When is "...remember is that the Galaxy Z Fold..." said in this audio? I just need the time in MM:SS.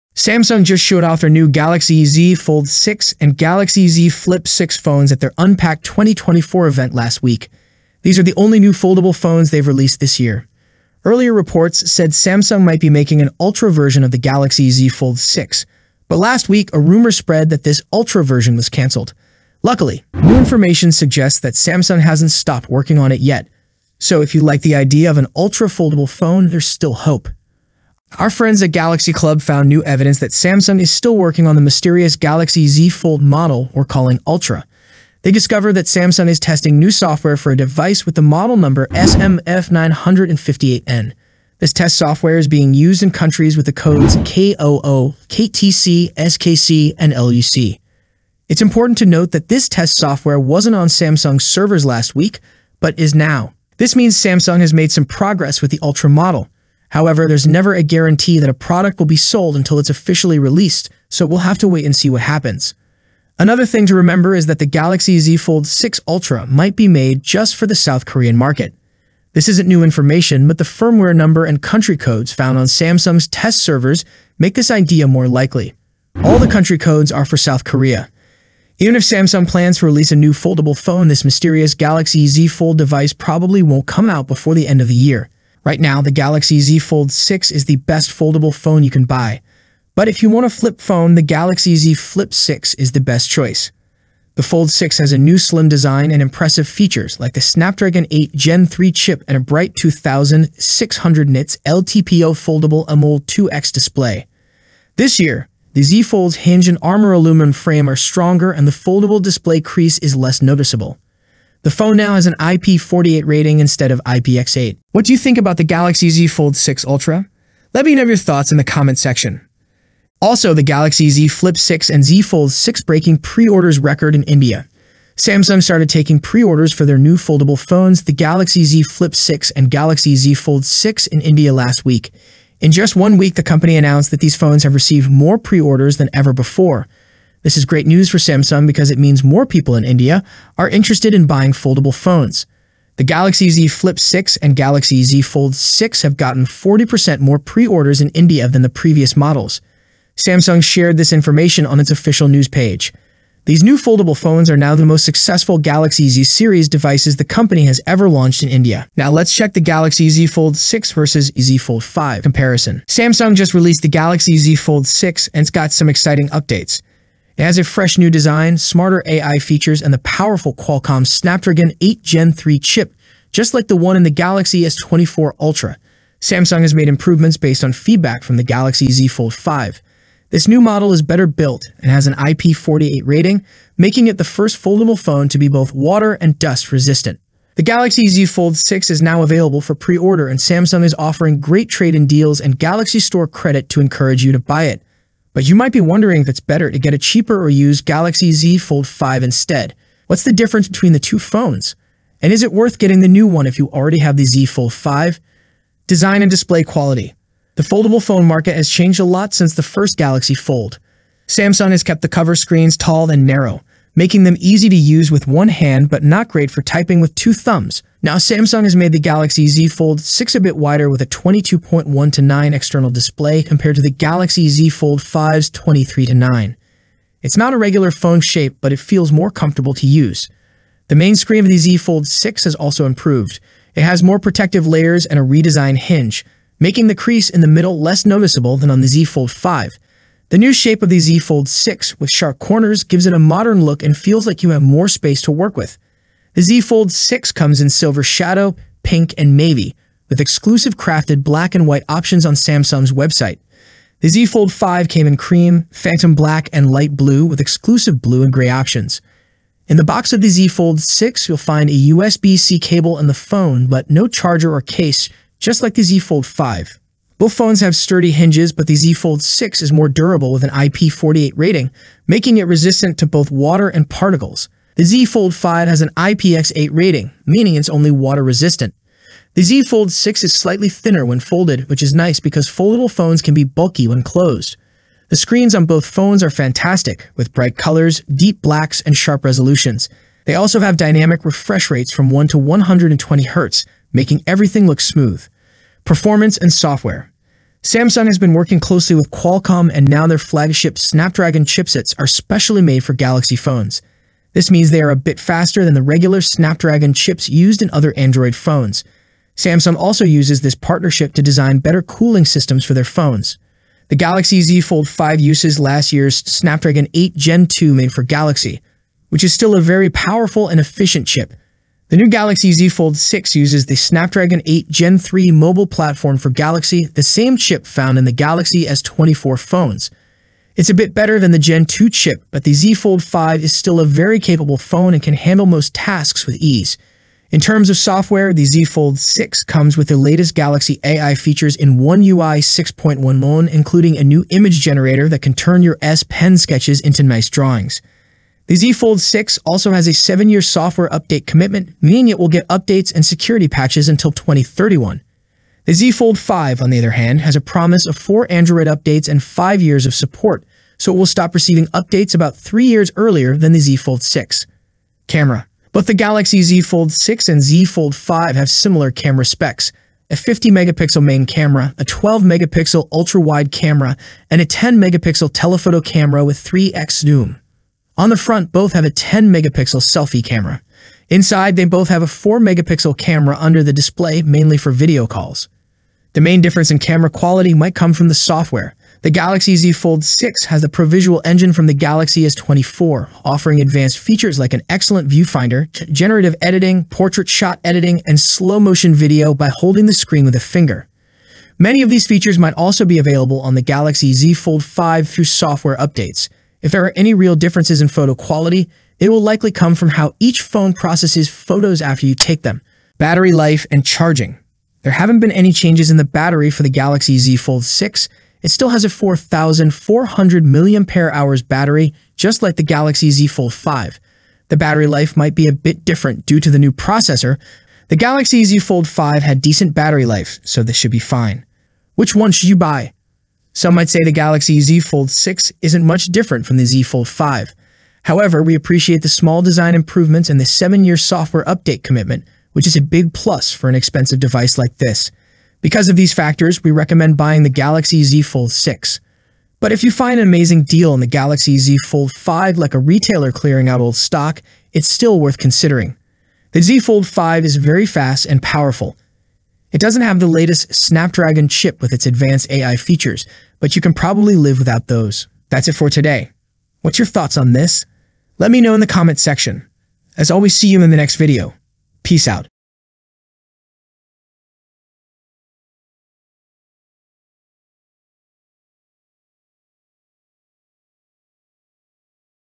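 01:03.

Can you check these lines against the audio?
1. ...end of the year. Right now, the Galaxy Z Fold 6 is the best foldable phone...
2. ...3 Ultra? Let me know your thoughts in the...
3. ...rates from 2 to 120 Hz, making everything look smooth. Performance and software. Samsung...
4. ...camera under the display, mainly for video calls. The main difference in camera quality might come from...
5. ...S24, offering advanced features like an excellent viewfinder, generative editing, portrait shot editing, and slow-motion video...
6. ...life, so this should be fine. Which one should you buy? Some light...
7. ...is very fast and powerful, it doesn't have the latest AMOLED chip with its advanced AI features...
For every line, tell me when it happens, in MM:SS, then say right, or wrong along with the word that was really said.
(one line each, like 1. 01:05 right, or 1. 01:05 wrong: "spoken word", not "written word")
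1. 01:24 right
2. 01:56 wrong: "6", not "3"
3. 04:51 wrong: "1", not "2"
4. 06:22 right
5. 06:32 right
6. 07:10 wrong: "might", not "light"
7. 07:37 wrong: "Snapdragon", not "AMOLED".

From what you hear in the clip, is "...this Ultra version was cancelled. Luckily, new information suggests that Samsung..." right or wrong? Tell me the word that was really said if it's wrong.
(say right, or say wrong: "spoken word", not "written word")
right.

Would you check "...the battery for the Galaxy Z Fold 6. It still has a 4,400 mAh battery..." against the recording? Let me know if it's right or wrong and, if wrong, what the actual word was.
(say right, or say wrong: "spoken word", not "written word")
right.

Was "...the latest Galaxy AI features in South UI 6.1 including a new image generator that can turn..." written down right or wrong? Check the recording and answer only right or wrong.
wrong.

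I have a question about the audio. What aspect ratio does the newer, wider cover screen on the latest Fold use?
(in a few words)
22.1 to 9.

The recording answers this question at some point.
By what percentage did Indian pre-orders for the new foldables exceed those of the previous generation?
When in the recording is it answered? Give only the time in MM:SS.
02:26.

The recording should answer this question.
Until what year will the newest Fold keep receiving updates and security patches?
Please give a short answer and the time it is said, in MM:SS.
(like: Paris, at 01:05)
2031, at 05:54.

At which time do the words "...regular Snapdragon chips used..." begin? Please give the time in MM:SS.
05:05.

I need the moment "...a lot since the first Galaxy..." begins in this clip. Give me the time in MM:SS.
03:28.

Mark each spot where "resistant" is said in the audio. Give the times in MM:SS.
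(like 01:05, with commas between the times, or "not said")
03:06, 04:32, 04:38.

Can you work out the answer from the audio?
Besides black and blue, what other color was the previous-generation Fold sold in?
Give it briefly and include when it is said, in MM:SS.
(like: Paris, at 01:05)
cream, at 04:15.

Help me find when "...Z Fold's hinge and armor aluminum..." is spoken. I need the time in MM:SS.
01:45.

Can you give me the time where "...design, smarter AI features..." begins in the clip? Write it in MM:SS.
02:48.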